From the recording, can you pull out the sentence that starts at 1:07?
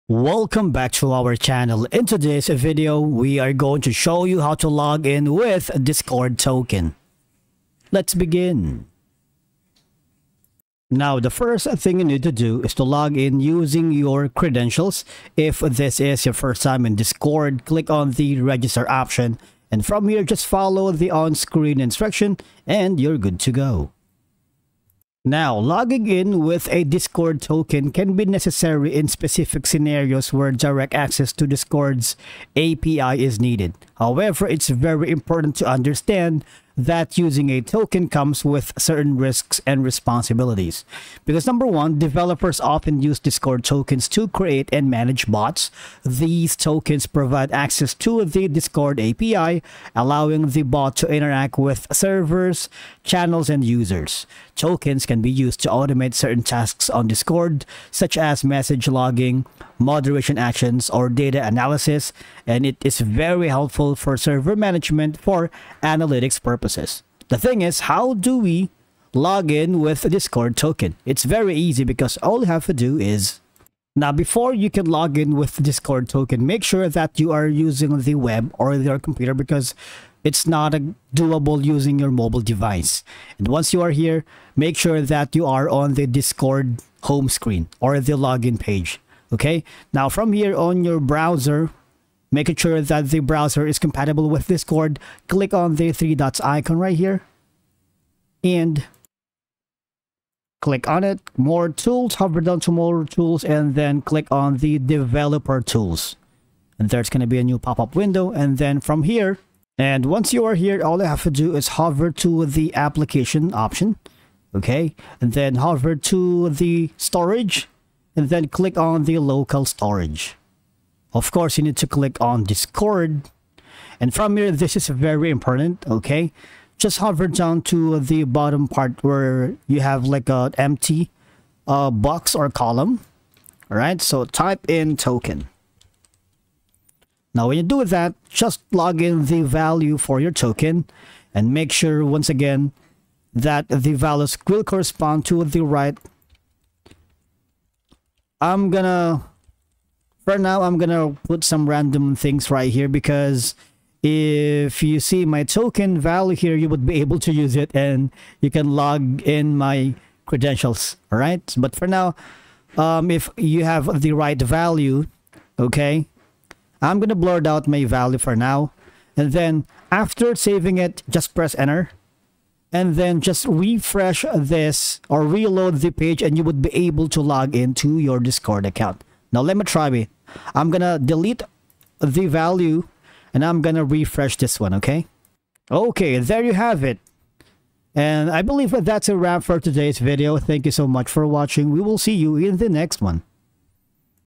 The thing is, how do we log in with Discord token?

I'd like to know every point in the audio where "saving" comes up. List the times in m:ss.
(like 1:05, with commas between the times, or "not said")
2:50.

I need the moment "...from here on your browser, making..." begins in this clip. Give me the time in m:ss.
1:30.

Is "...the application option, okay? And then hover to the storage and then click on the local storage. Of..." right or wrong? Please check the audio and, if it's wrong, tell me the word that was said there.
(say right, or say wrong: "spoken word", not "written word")
right.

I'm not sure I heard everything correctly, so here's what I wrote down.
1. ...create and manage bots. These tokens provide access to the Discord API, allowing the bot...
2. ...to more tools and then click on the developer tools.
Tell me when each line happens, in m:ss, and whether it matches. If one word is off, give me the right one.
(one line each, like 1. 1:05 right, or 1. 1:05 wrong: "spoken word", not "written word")
1. 0:44 right
2. 1:42 right.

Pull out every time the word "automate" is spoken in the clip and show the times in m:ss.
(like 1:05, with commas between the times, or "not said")
0:55.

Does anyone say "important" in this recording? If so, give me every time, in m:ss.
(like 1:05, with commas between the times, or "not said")
0:35, 2:05.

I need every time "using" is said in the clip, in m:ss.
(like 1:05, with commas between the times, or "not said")
0:13, 0:37, 1:17, 1:21.